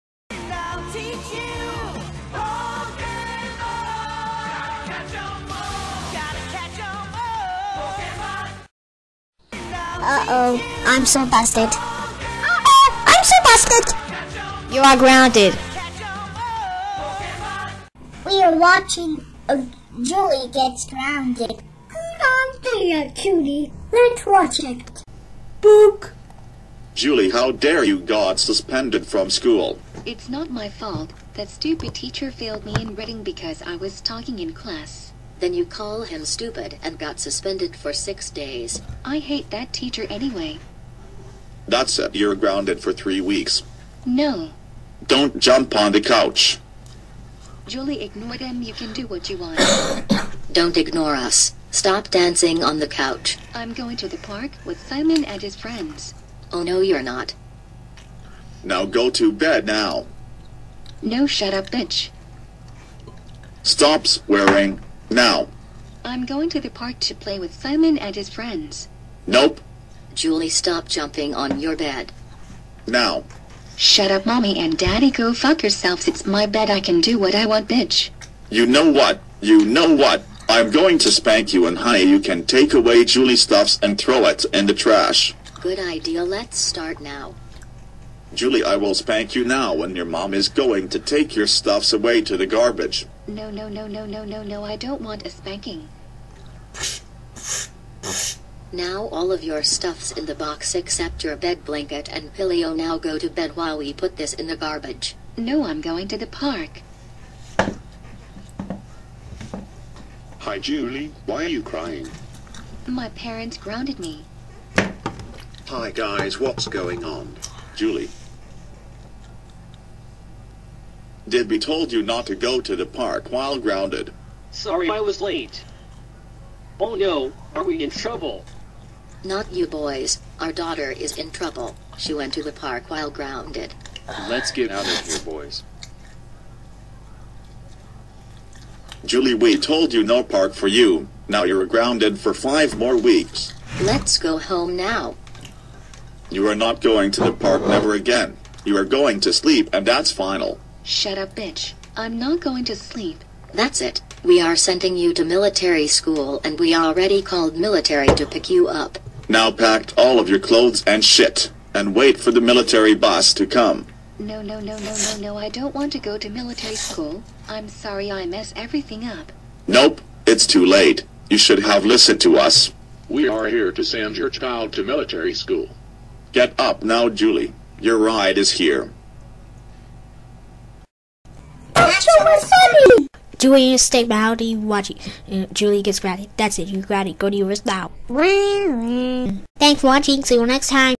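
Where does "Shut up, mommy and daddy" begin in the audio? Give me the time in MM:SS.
01:13.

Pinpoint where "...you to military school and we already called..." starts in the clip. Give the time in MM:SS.
02:34.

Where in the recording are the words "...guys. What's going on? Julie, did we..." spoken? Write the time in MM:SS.
01:55.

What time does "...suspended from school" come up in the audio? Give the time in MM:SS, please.
00:28.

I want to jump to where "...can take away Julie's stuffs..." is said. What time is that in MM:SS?
01:22.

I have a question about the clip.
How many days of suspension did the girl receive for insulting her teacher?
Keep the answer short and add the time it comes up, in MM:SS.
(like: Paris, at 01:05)
6, at 00:37.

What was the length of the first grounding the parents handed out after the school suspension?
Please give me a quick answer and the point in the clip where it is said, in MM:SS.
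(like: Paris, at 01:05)
3 weeks, at 00:42.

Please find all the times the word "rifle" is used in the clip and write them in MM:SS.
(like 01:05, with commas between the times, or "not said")
not said.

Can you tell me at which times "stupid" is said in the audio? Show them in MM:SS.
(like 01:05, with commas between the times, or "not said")
00:31, 00:36.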